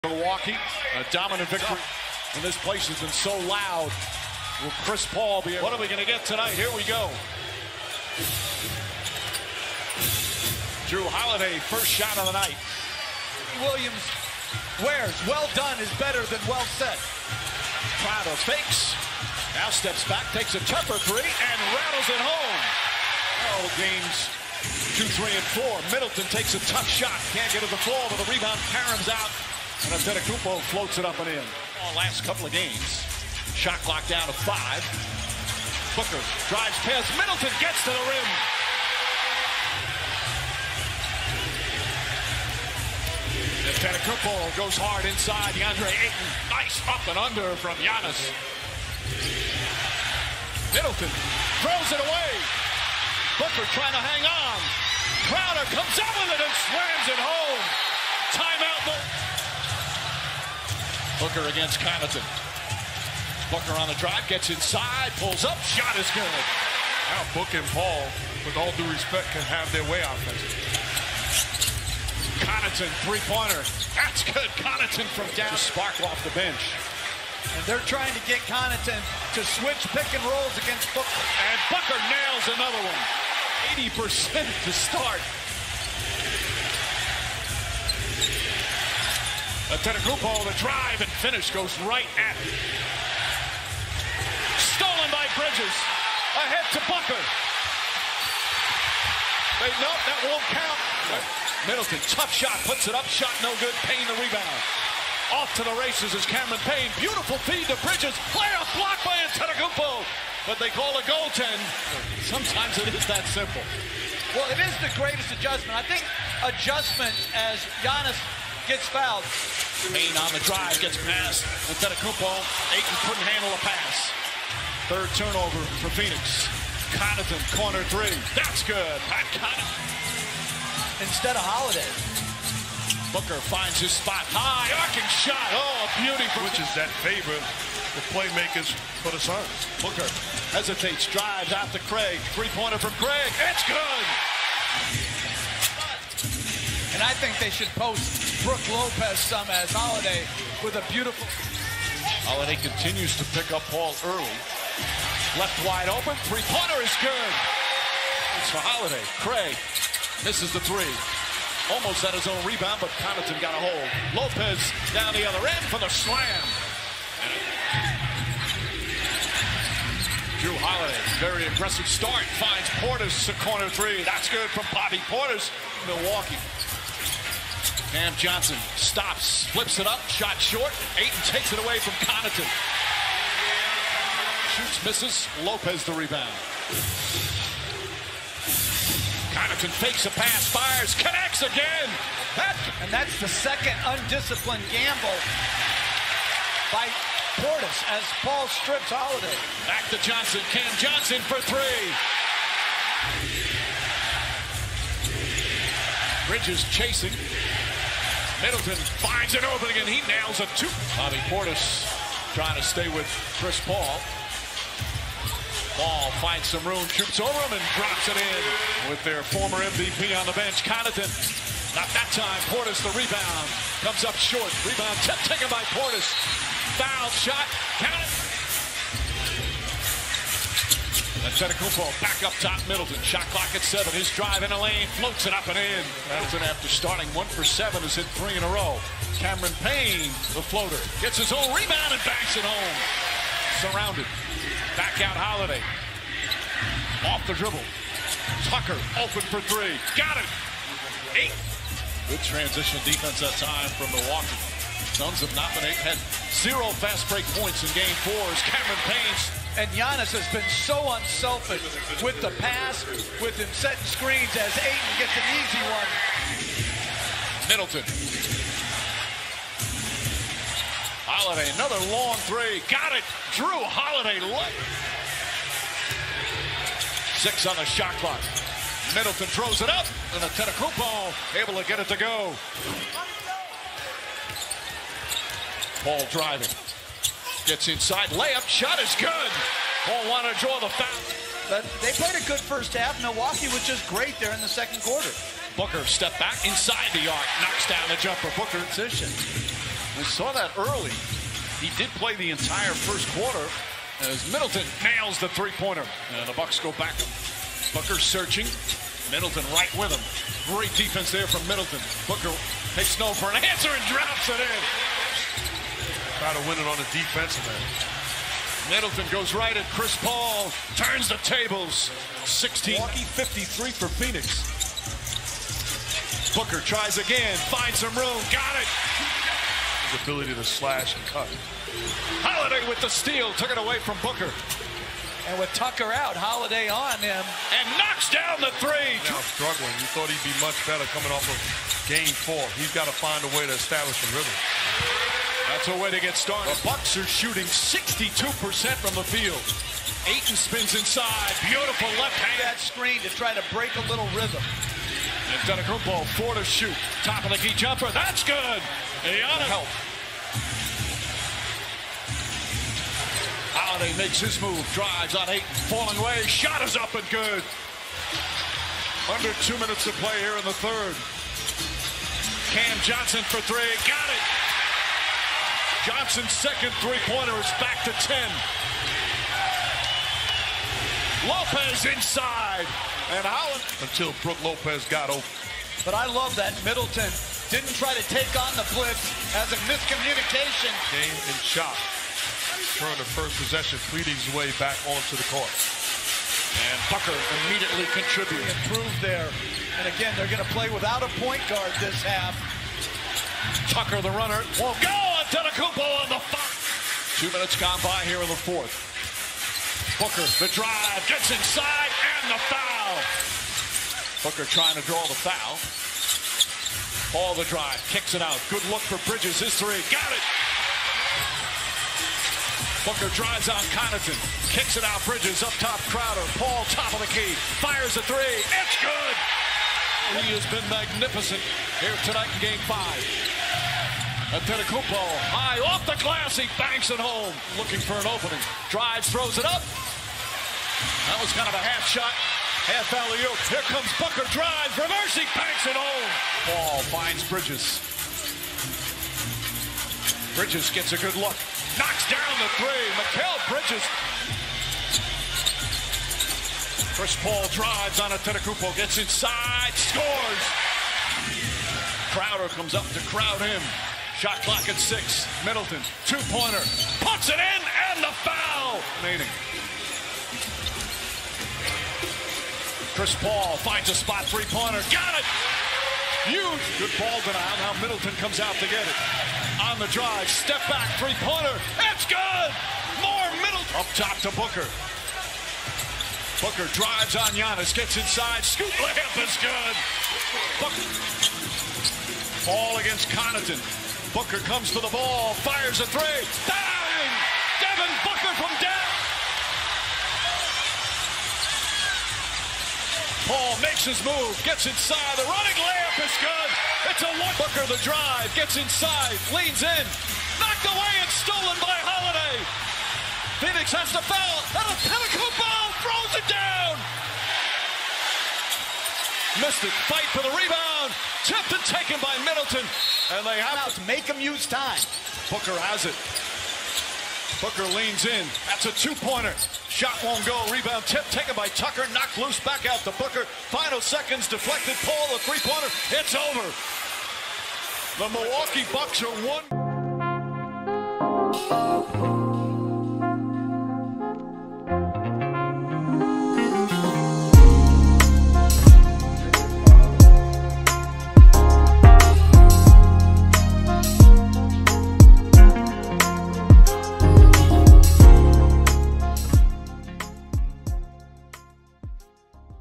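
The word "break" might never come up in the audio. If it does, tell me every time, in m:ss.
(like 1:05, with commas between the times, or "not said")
4:17, 5:53.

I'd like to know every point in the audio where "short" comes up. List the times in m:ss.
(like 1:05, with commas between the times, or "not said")
3:00, 3:44.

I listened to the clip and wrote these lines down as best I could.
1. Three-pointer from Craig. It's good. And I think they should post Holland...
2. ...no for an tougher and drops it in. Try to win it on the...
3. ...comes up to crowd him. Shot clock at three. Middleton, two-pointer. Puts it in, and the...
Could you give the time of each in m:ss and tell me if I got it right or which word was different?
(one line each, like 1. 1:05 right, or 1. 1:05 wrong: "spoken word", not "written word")
1. 2:22 wrong: "Brook", not "Holland"
2. 5:12 wrong: "answer", not "tougher"
3. 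7:42 wrong: "six", not "three".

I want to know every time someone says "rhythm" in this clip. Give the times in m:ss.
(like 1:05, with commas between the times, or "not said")
5:44, 5:54.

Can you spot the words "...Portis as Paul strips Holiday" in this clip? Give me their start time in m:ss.
3:17.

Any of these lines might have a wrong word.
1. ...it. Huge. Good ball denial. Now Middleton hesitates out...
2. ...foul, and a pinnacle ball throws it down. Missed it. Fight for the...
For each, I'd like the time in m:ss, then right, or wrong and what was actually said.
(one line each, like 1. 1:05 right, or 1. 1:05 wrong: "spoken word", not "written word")
1. 7:55 wrong: "comes", not "hesitates"
2. 8:34 right.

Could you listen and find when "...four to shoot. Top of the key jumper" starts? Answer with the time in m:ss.
5:56.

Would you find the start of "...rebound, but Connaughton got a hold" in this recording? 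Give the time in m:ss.
2:42.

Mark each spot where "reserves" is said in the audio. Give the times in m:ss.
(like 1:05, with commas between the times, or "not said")
not said.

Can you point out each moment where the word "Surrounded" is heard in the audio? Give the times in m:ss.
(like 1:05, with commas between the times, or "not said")
4:03.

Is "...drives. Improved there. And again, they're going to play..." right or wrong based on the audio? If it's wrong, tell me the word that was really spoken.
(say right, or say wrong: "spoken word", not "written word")
wrong: "contributes", not "drives".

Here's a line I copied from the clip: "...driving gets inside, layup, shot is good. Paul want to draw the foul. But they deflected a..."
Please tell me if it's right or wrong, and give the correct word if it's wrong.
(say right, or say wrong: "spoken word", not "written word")
wrong: "played", not "deflected".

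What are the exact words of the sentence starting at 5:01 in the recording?
He did play the entire first quarter as Middleton nails the three-pointer.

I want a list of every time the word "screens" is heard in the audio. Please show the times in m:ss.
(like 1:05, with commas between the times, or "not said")
4:23, 5:52.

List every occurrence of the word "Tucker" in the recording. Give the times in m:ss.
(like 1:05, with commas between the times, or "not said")
4:08, 5:35, 6:36, 6:43, 8:51.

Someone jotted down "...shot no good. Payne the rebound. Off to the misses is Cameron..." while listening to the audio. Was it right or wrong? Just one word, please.
wrong.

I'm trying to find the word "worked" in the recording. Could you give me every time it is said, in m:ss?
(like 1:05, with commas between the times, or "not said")
not said.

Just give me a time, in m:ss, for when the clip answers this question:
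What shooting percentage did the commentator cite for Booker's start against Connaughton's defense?
1:23.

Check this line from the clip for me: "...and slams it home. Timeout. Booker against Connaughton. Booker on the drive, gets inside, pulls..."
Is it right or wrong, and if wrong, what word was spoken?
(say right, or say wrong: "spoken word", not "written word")
right.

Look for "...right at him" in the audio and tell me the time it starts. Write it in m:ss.
1:31.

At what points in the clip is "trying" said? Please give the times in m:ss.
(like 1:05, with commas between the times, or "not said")
0:53, 1:17, 3:32, 6:54.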